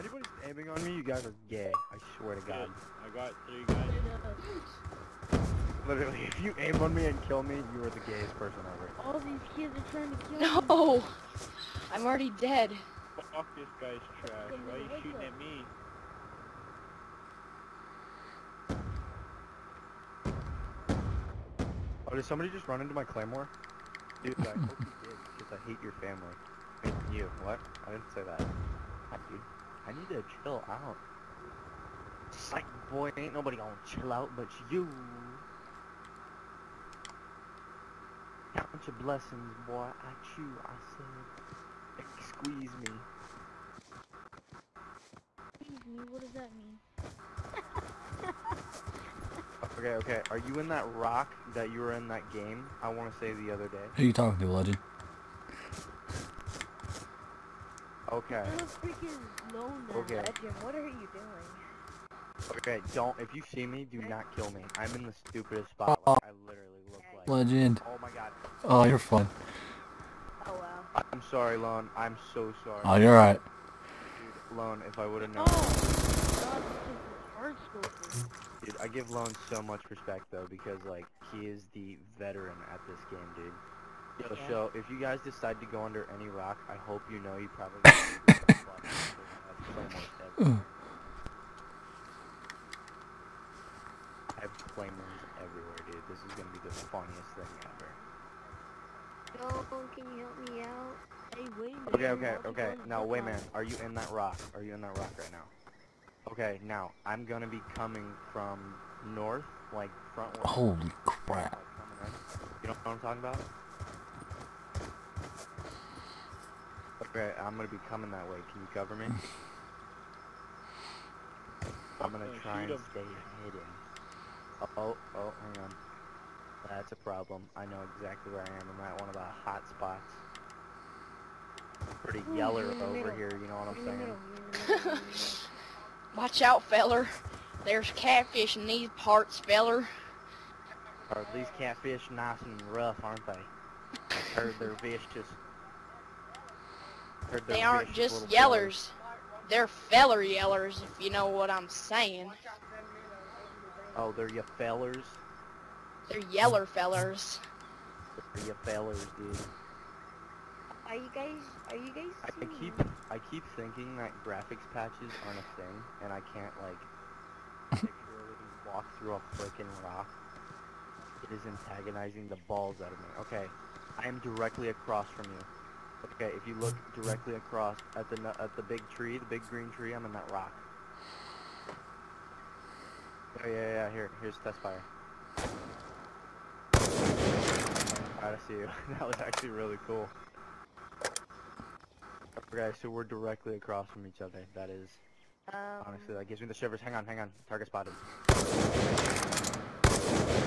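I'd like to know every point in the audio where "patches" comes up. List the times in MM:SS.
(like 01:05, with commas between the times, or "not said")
02:44.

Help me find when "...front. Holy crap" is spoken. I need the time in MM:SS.
01:50.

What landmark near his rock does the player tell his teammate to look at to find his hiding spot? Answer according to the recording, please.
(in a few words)
the big green tree.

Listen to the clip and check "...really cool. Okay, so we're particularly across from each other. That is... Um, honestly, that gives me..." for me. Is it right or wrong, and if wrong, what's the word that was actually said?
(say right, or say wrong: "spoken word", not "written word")
wrong: "directly", not "particularly".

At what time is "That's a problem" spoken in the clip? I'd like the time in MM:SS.
02:06.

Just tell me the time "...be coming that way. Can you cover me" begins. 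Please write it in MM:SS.
01:57.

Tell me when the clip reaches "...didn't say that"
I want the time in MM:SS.
00:27.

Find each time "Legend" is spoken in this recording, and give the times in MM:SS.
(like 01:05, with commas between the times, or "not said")
00:54, 01:00, 01:07.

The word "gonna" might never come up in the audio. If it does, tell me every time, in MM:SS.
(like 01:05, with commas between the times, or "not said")
00:33, 01:36, 01:47, 01:57, 02:02.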